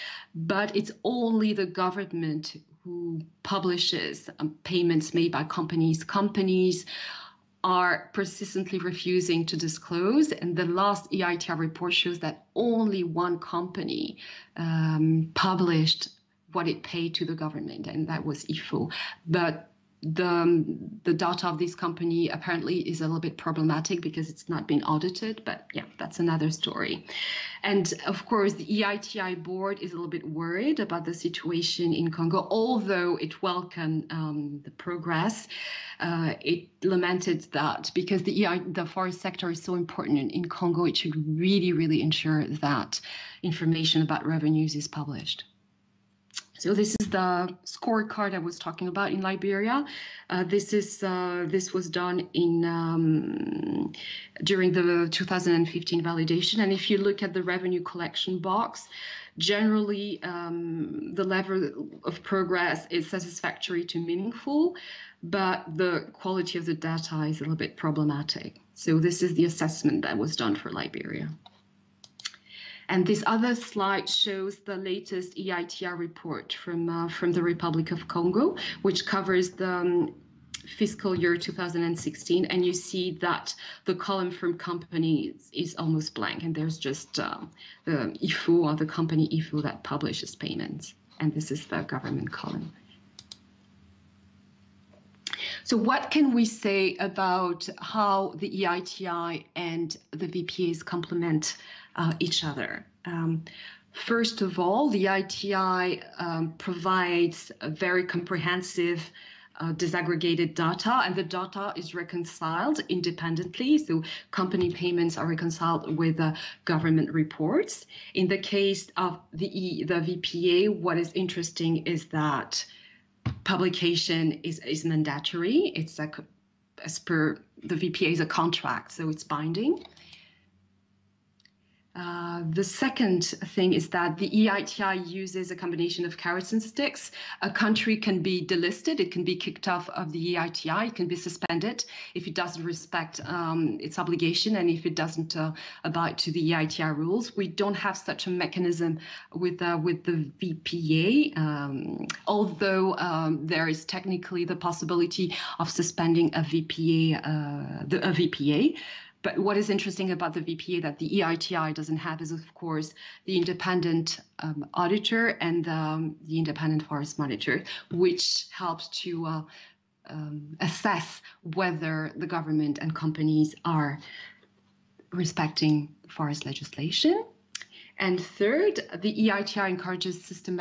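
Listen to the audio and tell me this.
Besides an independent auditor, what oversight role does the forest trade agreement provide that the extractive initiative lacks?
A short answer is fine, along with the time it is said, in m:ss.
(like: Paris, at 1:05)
independent forest monitor, at 2:46.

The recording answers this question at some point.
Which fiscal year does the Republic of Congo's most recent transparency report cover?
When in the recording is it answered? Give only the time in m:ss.
1:20.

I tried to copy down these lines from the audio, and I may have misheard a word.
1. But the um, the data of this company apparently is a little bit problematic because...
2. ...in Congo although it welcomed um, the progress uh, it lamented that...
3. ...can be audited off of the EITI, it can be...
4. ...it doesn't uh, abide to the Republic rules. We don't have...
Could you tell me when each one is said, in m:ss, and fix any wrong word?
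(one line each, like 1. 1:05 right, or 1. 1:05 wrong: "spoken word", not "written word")
1. 0:19 right
2. 0:31 right
3. 2:19 wrong: "kicked", not "audited"
4. 2:24 wrong: "EITI", not "Republic".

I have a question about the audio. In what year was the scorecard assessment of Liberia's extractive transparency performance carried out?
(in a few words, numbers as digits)
2015.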